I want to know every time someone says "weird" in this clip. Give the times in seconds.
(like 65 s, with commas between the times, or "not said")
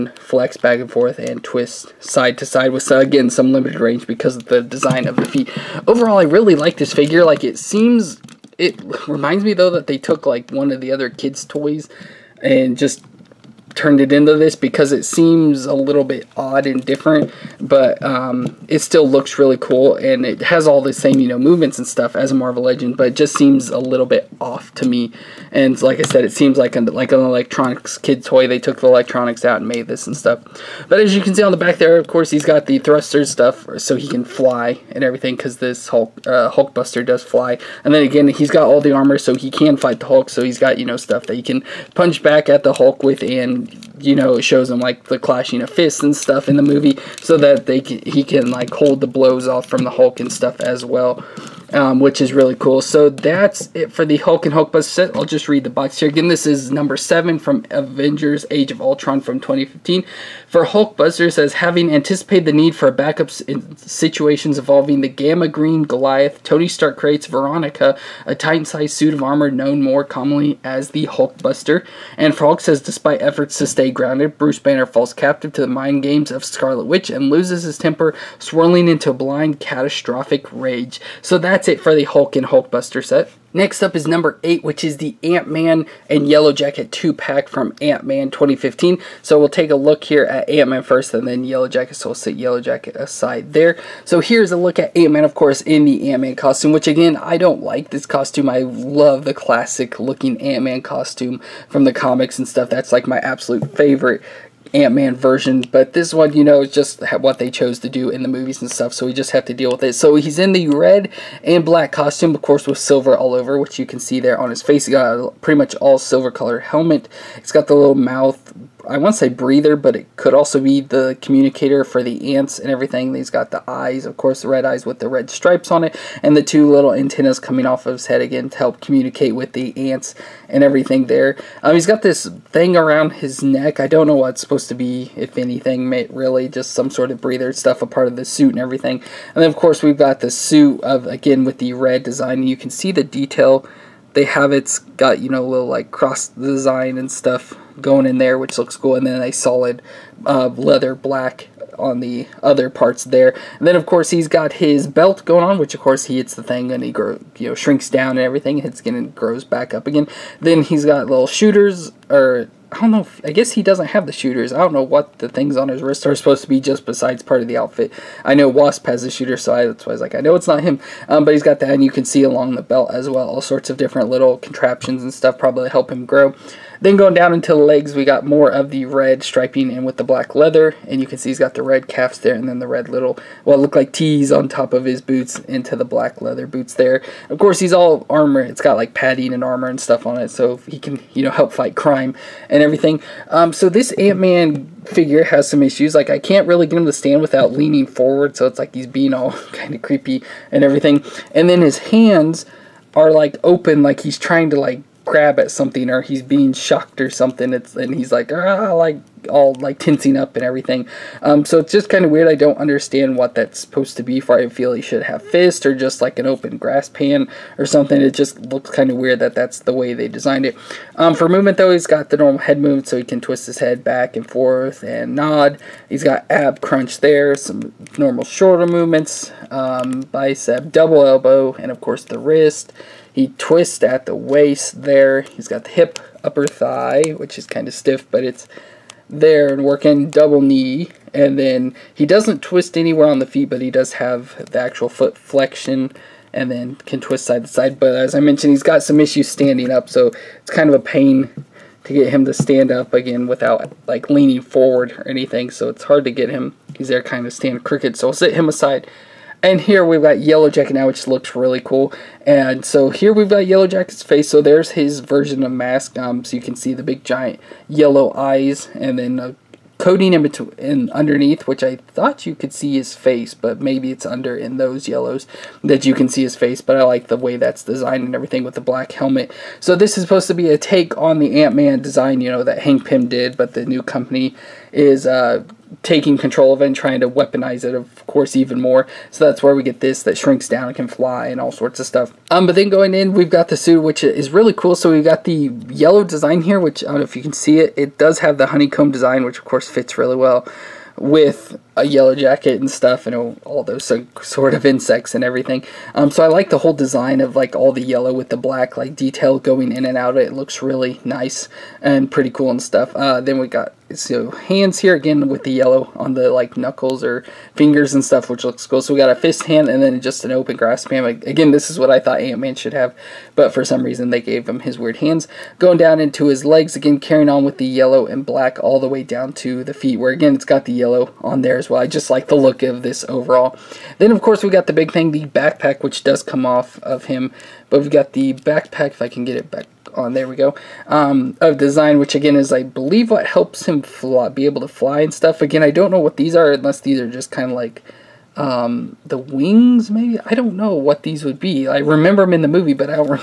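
212 s, 218 s, 324 s.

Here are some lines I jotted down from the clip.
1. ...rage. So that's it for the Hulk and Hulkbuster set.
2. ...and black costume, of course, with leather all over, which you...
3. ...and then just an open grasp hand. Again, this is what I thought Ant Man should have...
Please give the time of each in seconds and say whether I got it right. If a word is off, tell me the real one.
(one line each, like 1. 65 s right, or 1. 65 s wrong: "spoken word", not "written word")
1. 80 s right
2. 111 s wrong: "silver", not "leather"
3. 319 s right.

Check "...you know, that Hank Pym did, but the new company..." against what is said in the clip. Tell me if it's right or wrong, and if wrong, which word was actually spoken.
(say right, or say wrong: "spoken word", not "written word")
right.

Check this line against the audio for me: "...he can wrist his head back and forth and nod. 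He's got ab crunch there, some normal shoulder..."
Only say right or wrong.
wrong.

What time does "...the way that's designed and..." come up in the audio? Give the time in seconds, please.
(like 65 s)
277 s.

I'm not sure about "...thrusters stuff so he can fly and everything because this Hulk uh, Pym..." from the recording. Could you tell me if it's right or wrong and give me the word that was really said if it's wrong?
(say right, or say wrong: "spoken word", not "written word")
wrong: "Hulkbuster", not "Pym".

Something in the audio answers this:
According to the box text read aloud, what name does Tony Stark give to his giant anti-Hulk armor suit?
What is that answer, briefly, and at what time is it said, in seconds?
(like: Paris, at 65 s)
Veronica, at 67 s.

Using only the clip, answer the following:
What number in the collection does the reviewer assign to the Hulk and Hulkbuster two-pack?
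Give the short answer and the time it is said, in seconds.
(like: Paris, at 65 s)
7, at 56 s.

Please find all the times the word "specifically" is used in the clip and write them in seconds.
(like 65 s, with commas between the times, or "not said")
not said.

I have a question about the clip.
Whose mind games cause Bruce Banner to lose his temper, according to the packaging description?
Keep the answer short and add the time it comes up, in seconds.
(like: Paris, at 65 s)
Scarlet Witch, at 76 s.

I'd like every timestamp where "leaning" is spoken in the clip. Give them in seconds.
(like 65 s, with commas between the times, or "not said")
197 s, 254 s.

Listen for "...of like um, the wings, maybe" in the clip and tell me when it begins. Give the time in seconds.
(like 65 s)
347 s.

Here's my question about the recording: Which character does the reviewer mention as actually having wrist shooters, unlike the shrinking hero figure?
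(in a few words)
Wasp.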